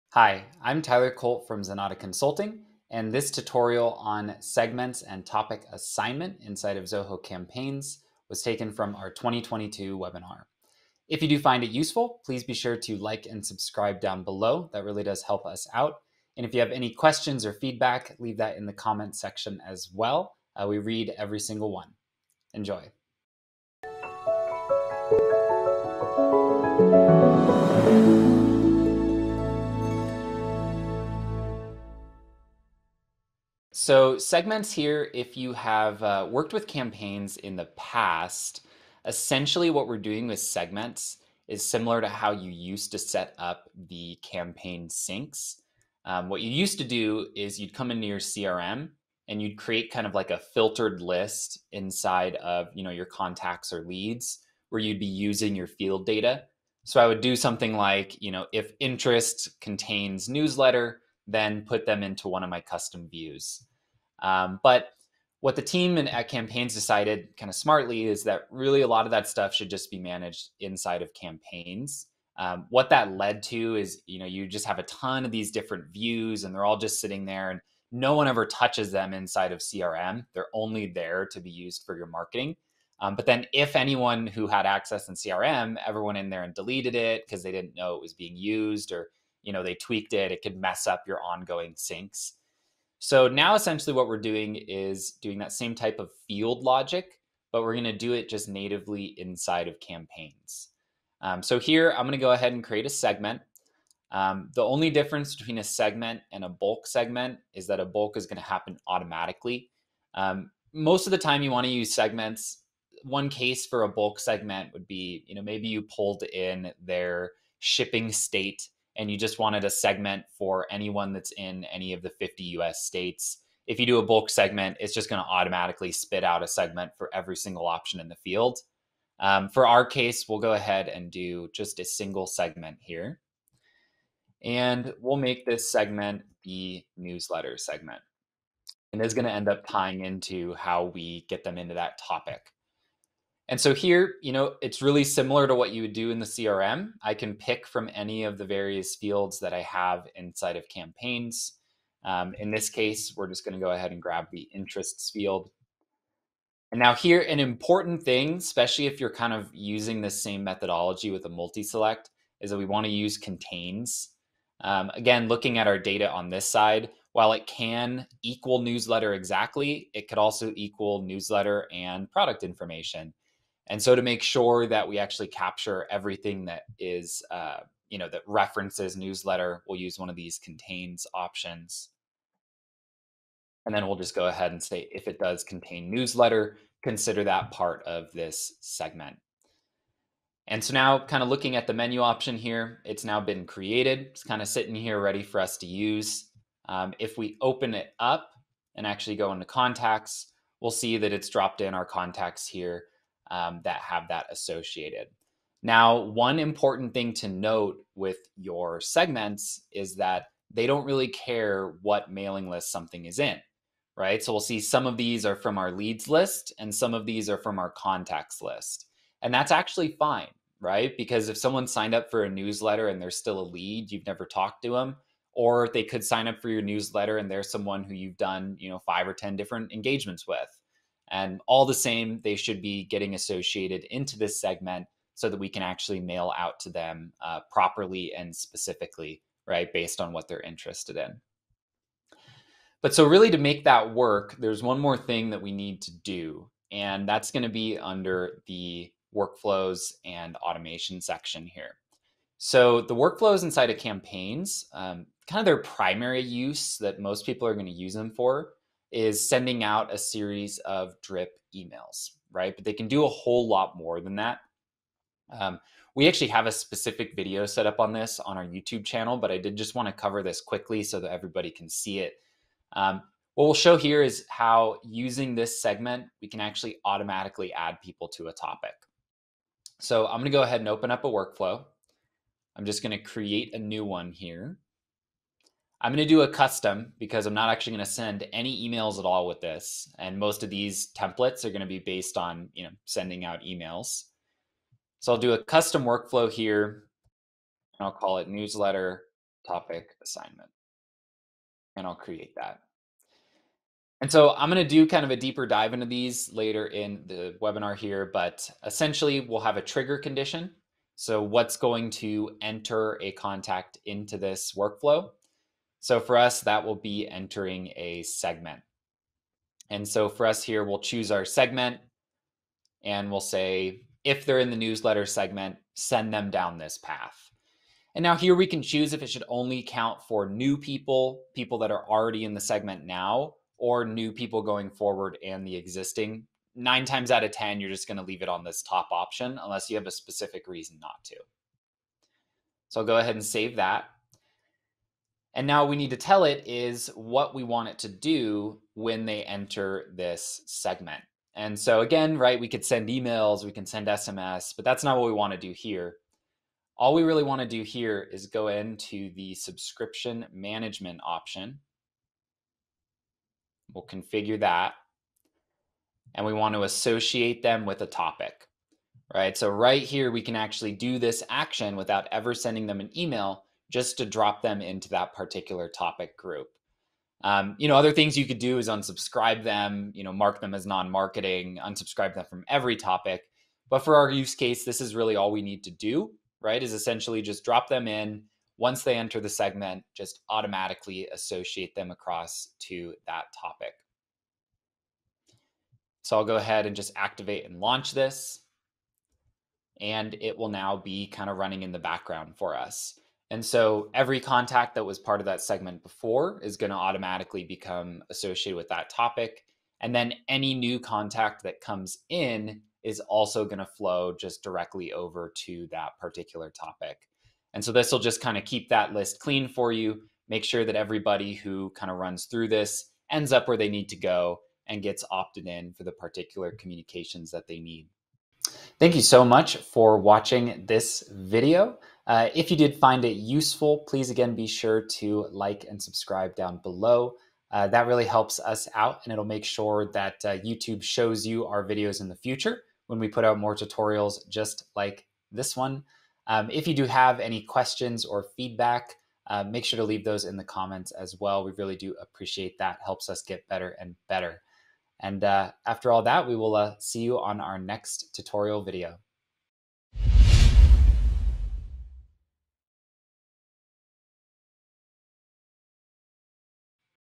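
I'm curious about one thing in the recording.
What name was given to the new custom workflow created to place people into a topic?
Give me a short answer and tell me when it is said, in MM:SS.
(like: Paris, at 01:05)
Newsletter topic assignment, at 04:58.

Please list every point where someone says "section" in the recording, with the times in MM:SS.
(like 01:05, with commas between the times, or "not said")
00:19, 04:11.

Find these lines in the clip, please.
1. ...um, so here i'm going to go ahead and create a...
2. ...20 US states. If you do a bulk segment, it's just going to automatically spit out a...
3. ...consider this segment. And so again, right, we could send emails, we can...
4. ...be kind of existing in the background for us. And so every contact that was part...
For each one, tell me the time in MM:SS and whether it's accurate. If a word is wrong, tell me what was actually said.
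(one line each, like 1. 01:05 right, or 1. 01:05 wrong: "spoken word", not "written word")
1. 01:41 right
2. 02:02 wrong: "50", not "20"
3. 05:49 wrong: "enter", not "consider"
4. 06:40 wrong: "running", not "existing".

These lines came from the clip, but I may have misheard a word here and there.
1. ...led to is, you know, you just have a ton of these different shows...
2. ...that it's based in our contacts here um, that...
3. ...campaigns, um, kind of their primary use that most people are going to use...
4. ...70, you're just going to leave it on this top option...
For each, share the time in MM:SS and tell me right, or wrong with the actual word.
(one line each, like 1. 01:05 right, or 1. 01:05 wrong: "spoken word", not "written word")
1. 01:13 wrong: "views", not "shows"
2. 03:20 wrong: "dropped", not "based"
3. 04:13 right
4. 05:37 wrong: "10", not "70".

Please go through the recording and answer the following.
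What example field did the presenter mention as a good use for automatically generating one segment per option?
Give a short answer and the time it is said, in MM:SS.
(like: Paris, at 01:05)
Shipping state, at 01:57.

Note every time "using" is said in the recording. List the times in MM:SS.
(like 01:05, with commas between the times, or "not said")
00:55, 02:39, 04:34.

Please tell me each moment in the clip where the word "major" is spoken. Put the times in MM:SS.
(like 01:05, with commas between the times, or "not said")
not said.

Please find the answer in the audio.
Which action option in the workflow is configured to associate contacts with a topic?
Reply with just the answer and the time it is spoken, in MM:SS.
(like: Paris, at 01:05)
Subscription management, at 05:59.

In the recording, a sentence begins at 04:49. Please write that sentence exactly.
And most of these templates are going to be based on, you know, sending out emails.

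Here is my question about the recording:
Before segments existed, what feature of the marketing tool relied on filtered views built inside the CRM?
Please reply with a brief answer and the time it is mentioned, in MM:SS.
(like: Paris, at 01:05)
Campaign syncs, at 00:44.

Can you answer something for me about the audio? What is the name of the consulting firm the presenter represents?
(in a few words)
Zenatta Consulting.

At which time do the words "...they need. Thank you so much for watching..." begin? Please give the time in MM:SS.
07:07.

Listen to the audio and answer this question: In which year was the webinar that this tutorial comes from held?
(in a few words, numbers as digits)
2022.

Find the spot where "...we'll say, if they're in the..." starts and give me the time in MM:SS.
05:23.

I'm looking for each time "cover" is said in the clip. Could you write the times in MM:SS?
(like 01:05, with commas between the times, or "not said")
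04:29.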